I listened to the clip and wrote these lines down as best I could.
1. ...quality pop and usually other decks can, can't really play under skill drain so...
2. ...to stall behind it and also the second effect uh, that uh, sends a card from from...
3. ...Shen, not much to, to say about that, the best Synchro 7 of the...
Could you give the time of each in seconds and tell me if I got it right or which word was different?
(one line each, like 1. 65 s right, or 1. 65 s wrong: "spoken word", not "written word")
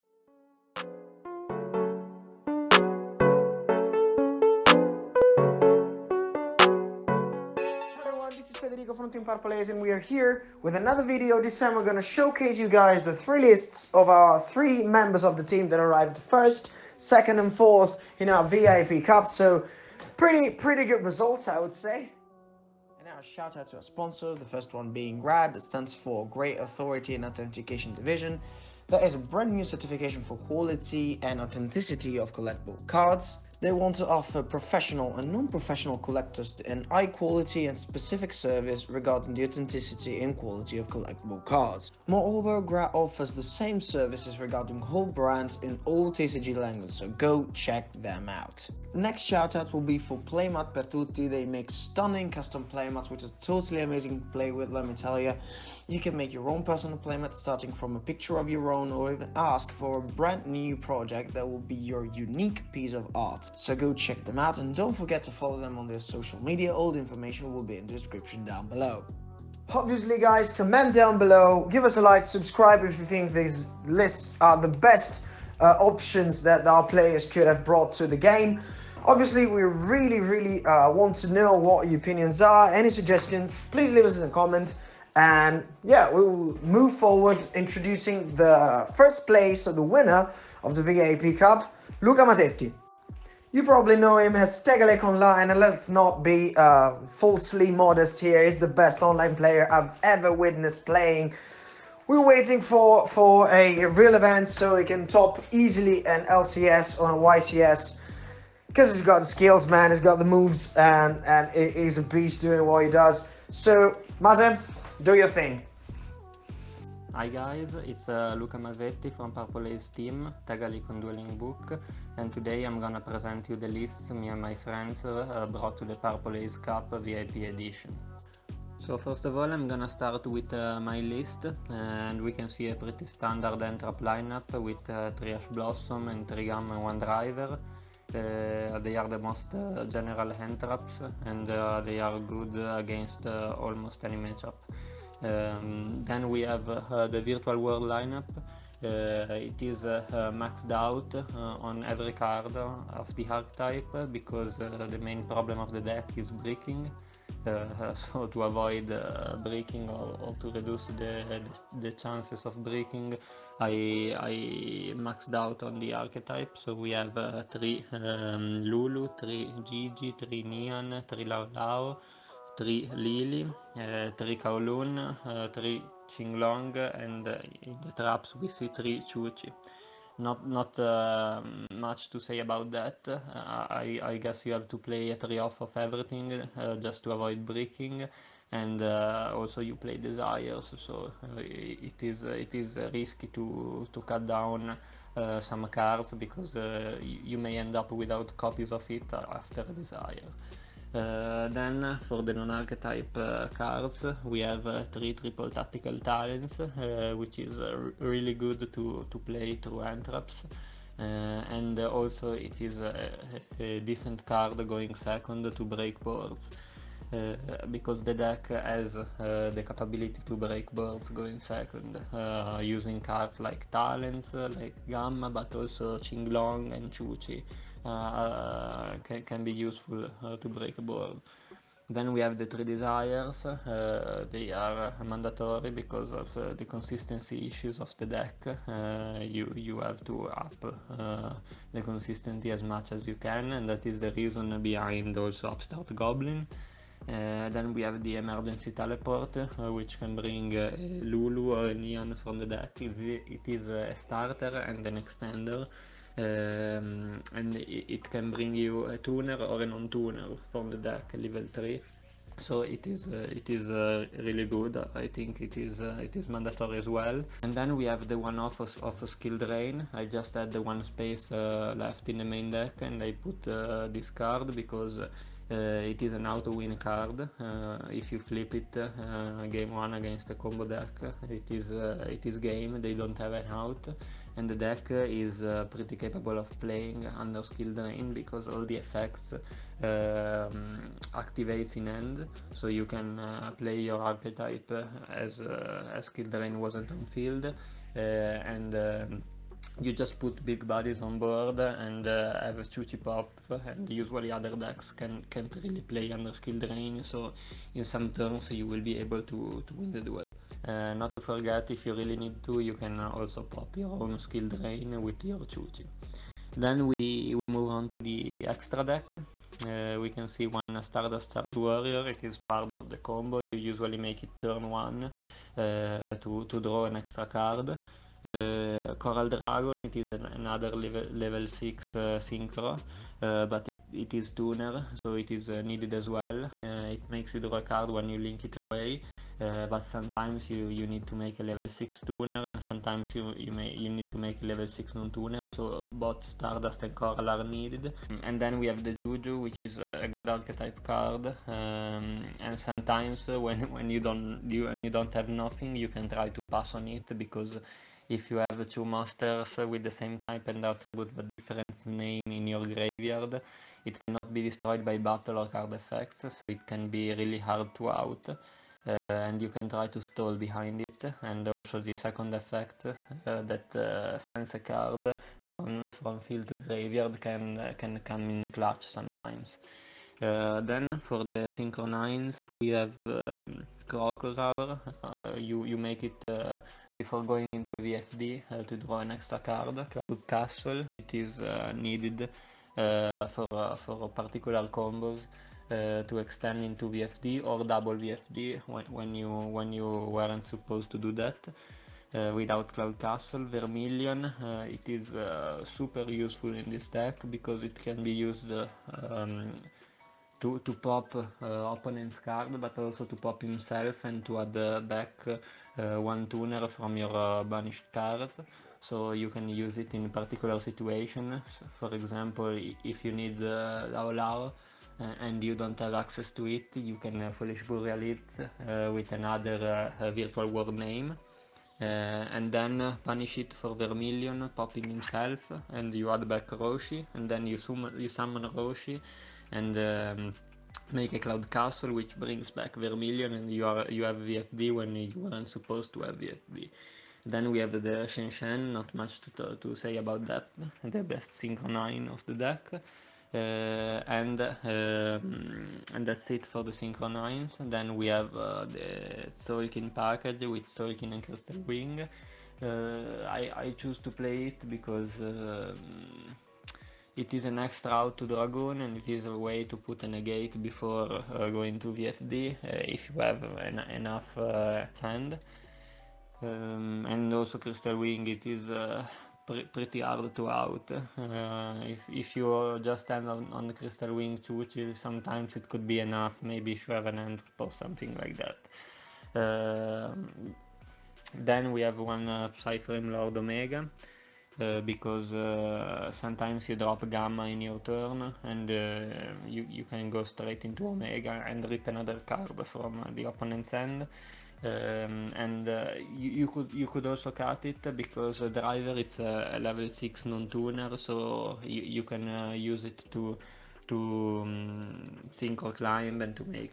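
1. 302 s wrong: "shooty", not "quality"
2. 369 s right
3. 448 s wrong: "9", not "7".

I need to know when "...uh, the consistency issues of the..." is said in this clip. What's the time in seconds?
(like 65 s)
236 s.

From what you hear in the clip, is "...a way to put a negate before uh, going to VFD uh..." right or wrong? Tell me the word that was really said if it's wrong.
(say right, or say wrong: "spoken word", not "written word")
right.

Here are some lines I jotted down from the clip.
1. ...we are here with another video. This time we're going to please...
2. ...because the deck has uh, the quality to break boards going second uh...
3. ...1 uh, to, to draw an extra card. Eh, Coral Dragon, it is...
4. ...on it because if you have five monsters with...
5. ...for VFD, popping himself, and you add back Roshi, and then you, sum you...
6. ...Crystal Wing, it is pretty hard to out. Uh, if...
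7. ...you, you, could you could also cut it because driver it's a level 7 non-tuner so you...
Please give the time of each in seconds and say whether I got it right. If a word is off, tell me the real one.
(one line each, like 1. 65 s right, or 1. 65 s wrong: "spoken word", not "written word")
1. 9 s wrong: "showcase", not "please"
2. 217 s wrong: "capability", not "quality"
3. 324 s right
4. 356 s wrong: "two", not "five"
5. 433 s wrong: "Vermilion", not "VFD"
6. 477 s right
7. 506 s wrong: "6", not "7".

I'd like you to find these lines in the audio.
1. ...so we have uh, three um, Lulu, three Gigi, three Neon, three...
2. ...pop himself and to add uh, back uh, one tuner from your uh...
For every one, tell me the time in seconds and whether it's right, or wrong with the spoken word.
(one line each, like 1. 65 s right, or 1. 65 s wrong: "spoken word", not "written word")
1. 166 s right
2. 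413 s right.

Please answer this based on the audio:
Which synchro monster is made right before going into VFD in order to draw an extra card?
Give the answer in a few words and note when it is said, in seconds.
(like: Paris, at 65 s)
Crocodile, at 383 s.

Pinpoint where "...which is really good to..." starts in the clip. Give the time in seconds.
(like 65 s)
207 s.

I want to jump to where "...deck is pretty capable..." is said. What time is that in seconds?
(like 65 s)
284 s.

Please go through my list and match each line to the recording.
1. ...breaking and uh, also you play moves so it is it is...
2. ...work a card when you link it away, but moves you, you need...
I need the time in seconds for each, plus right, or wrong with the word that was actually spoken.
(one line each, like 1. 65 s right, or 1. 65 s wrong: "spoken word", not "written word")
1. 187 s wrong: "desires", not "moves"
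2. 337 s wrong: "sometimes", not "moves".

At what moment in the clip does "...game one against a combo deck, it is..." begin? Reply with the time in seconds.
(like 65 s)
279 s.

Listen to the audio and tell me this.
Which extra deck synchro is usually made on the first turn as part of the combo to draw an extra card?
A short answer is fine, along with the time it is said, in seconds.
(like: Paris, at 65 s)
Stardust Warrior, at 320 s.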